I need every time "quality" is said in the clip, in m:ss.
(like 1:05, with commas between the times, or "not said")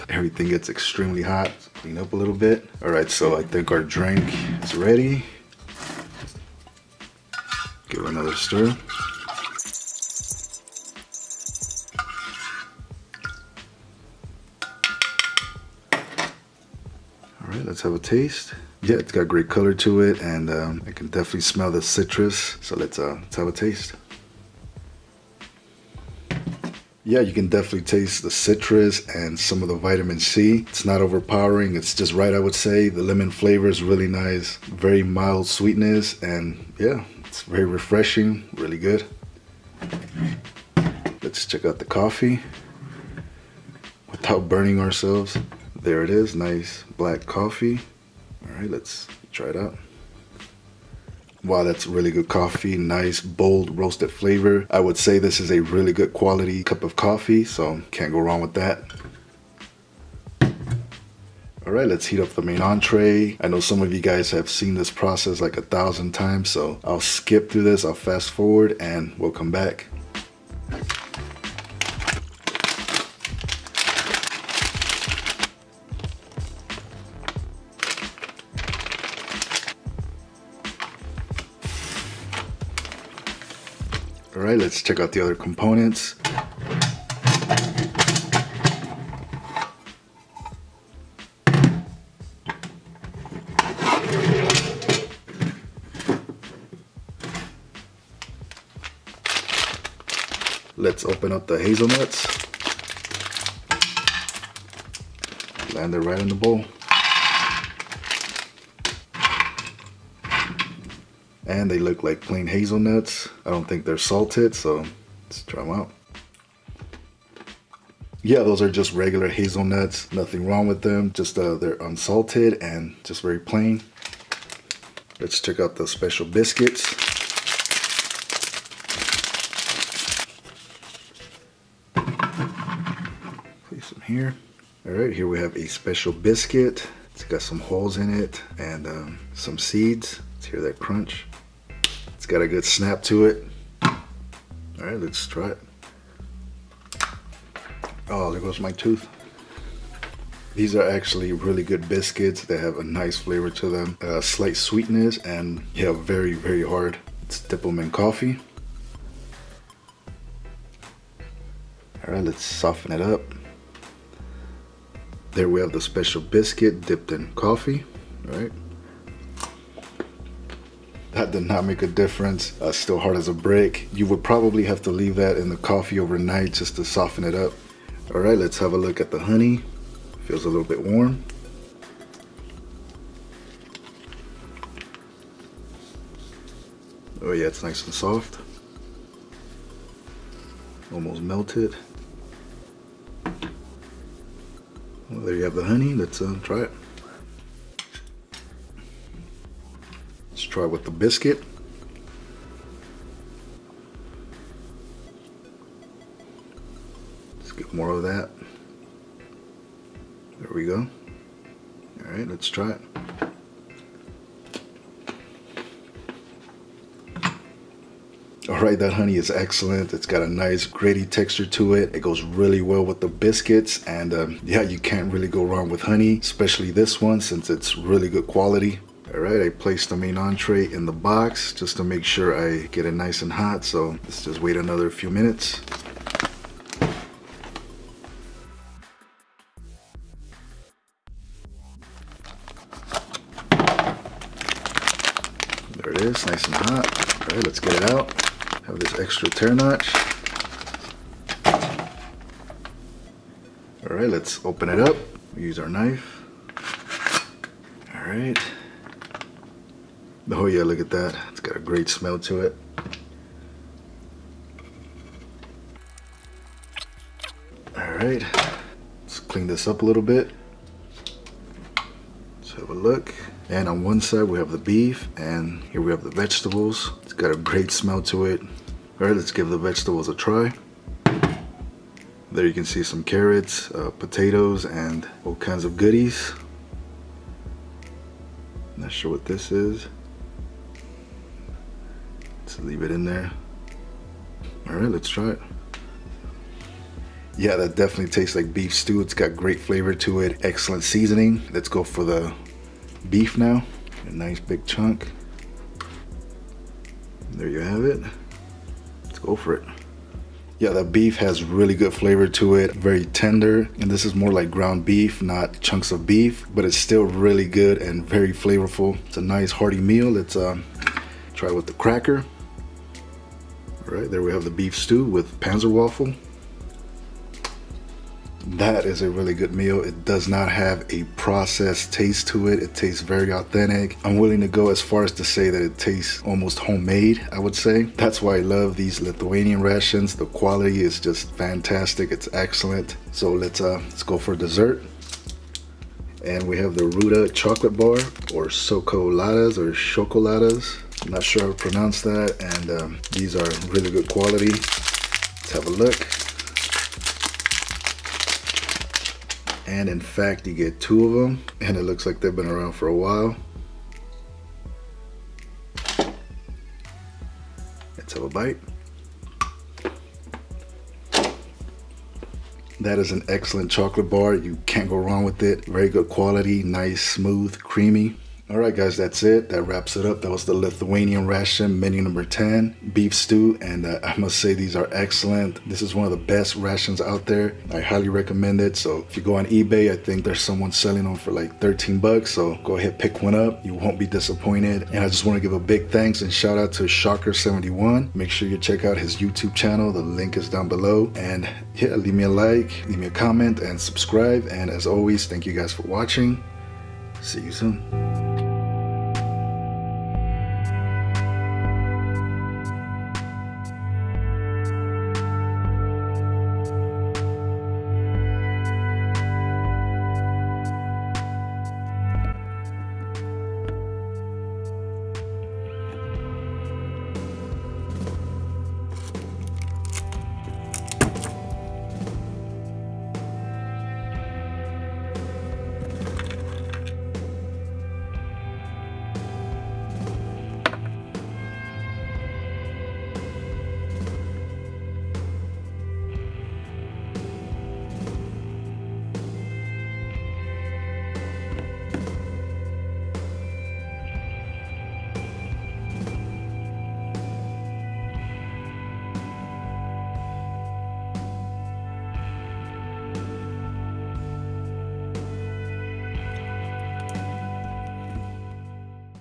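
0:56, 3:48, 5:40, 5:54, 6:16.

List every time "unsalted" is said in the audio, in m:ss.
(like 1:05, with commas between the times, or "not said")
2:01.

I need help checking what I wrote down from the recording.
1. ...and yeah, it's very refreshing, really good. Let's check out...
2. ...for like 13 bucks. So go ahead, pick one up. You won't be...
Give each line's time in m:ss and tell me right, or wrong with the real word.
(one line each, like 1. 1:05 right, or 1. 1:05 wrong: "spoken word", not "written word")
1. 0:36 right
2. 6:31 right.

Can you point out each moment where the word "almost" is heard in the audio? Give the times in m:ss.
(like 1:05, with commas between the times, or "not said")
3:10, 5:36.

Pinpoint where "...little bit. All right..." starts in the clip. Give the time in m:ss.
0:02.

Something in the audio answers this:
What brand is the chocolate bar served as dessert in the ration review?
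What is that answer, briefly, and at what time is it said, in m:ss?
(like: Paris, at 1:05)
Ruta, at 5:46.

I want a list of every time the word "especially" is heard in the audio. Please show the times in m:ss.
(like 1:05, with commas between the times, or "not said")
3:46.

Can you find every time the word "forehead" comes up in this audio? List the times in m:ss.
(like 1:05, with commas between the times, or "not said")
not said.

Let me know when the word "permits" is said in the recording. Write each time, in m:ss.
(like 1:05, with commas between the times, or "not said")
not said.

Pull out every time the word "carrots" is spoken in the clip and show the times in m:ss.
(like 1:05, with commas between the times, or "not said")
4:43.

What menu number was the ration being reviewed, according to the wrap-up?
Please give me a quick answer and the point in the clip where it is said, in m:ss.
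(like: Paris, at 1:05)
10, at 6:22.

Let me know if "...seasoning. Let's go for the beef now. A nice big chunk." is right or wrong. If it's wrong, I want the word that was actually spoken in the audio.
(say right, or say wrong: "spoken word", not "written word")
right.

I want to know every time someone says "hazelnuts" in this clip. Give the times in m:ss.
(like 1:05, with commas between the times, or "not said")
1:41, 1:52, 1:59.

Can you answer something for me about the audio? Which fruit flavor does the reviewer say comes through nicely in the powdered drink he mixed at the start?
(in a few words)
Lemon.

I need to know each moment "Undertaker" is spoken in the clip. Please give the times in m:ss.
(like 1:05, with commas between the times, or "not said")
not said.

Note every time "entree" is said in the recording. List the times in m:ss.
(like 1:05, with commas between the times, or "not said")
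1:02, 3:50.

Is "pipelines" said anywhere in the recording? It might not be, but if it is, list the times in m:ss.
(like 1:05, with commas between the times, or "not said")
not said.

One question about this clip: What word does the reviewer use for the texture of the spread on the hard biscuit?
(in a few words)
Gritty.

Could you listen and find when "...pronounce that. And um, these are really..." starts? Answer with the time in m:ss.
5:51.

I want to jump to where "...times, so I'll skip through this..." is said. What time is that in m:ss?
1:06.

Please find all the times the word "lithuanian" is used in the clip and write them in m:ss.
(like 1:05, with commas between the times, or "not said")
5:39, 6:20.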